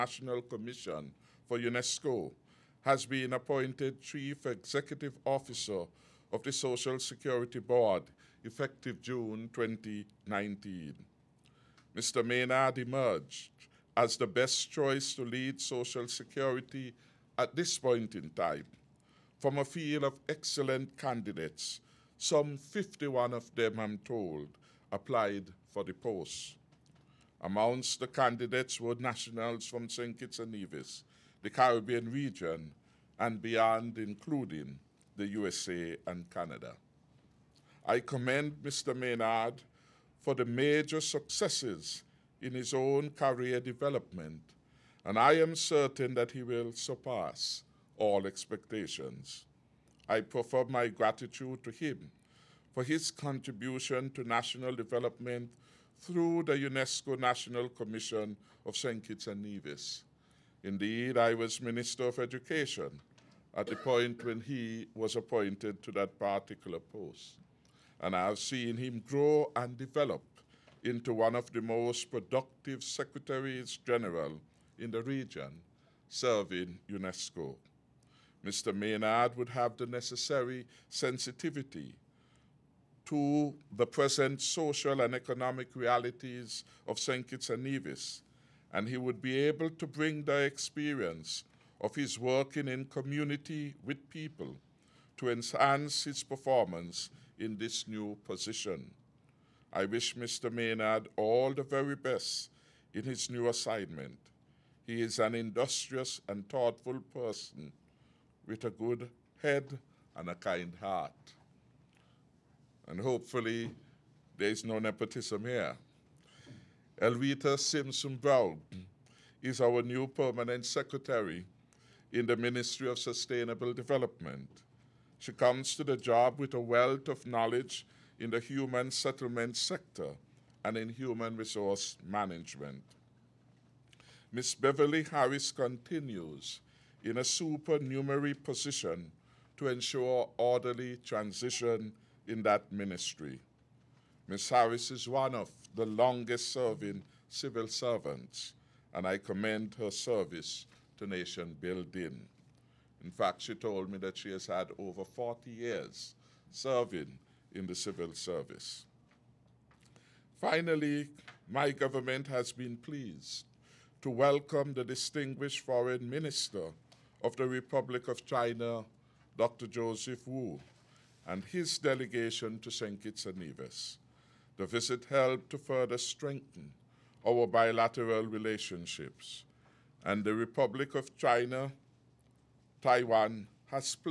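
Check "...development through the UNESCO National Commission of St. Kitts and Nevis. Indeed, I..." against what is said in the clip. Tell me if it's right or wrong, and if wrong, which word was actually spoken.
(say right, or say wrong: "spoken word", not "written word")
right.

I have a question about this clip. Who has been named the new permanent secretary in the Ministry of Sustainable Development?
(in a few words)
Elvita Simpson Brown.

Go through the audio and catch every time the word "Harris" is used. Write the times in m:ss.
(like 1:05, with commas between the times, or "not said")
2:15, 2:24.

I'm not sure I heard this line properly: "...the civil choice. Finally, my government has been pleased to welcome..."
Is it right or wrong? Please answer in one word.
wrong.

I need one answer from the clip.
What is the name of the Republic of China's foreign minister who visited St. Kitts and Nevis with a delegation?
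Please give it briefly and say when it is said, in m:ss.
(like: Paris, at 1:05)
Joseph Wu, at 2:49.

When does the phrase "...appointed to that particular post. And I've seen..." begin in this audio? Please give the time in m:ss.
1:05.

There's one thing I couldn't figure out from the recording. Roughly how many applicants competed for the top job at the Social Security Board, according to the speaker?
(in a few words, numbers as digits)
51.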